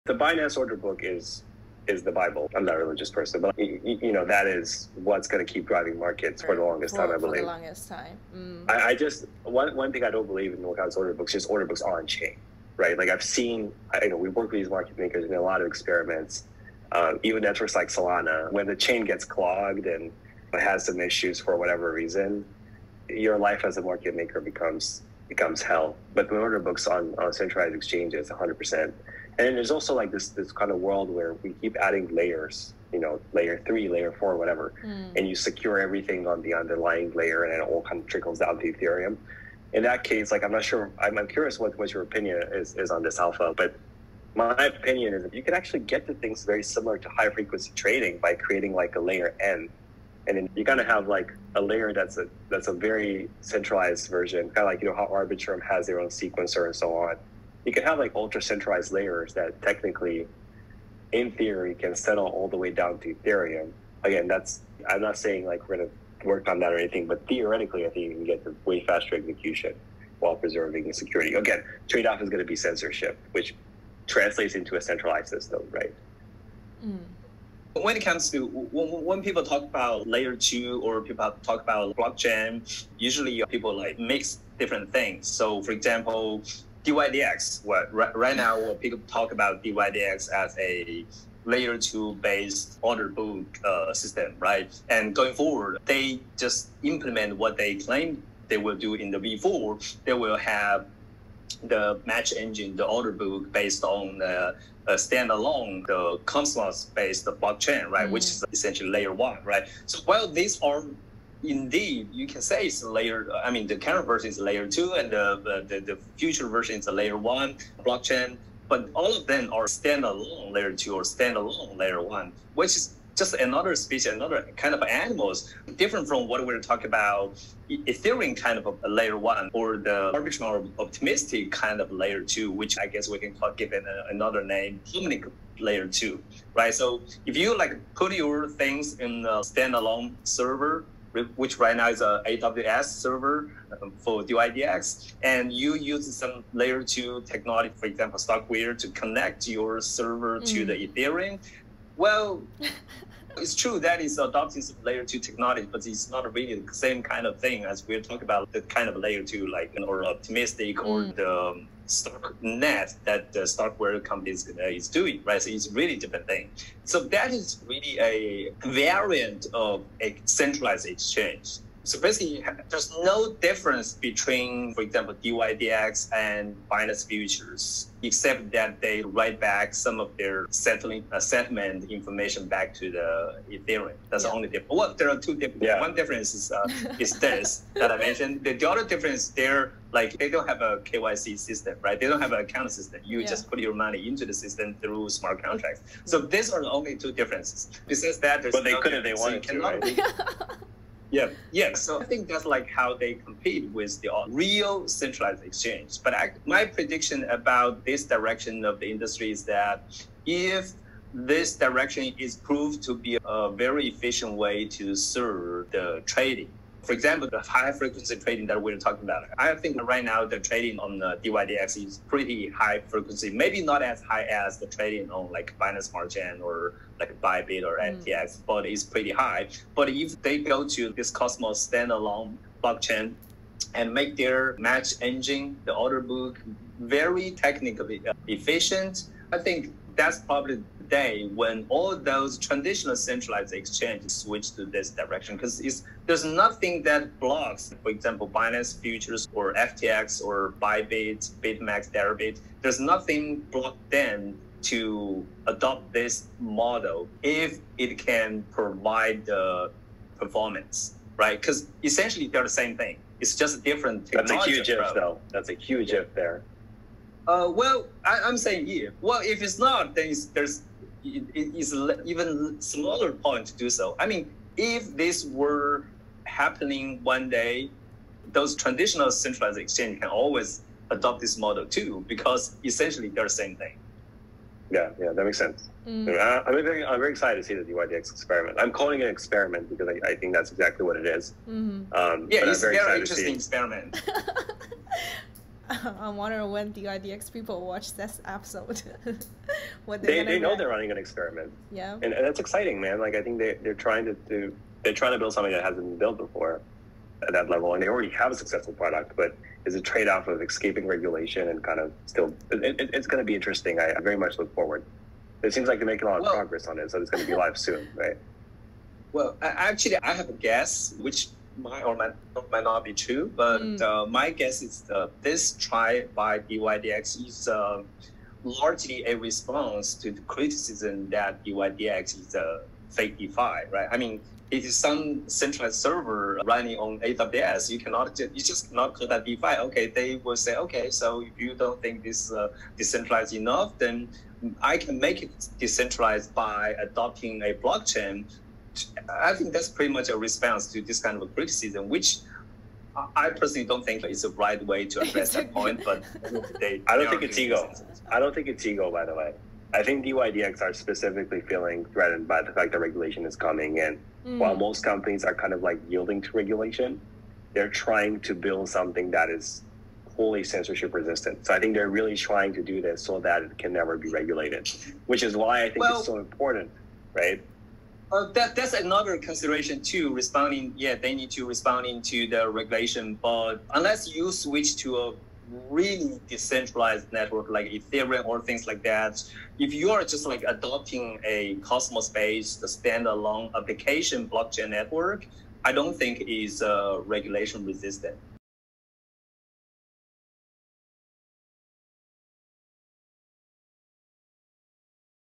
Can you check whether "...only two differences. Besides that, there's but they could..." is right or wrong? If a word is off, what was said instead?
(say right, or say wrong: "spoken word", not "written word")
right.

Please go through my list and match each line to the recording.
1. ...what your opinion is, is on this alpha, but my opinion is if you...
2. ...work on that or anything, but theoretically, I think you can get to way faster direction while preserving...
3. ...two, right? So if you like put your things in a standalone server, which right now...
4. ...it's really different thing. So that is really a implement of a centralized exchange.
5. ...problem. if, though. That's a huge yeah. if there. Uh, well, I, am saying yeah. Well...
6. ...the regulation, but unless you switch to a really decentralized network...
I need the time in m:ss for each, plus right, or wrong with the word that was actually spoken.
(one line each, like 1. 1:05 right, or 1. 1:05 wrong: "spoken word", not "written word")
1. 0:41 right
2. 1:06 wrong: "execution", not "direction"
3. 2:15 right
4. 2:45 wrong: "variant", not "implement"
5. 4:24 right
6. 6:22 right.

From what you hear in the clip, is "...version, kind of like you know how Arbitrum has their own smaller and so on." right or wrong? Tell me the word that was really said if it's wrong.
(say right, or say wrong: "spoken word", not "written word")
wrong: "sequencer", not "smaller".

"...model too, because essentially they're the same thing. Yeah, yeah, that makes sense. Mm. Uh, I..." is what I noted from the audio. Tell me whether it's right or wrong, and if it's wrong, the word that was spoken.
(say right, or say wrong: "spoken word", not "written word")
right.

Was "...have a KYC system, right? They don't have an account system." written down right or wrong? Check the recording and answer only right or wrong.
right.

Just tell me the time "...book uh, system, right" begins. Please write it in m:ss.
1:33.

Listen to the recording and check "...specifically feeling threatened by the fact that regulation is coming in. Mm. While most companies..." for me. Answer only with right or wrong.
right.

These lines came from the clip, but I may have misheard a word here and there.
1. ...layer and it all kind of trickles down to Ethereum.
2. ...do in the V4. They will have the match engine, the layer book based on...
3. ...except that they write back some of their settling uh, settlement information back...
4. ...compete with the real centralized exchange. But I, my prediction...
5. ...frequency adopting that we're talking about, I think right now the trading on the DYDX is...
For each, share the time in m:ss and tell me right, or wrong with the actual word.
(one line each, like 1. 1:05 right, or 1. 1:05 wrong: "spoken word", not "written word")
1. 0:37 right
2. 1:38 wrong: "order", not "layer"
3. 2:58 right
4. 3:23 right
5. 3:37 wrong: "trading", not "adopting".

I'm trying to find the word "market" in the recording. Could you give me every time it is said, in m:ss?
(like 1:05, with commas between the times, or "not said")
0:05, 0:14, 0:23.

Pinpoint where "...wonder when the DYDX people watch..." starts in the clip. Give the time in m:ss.
4:56.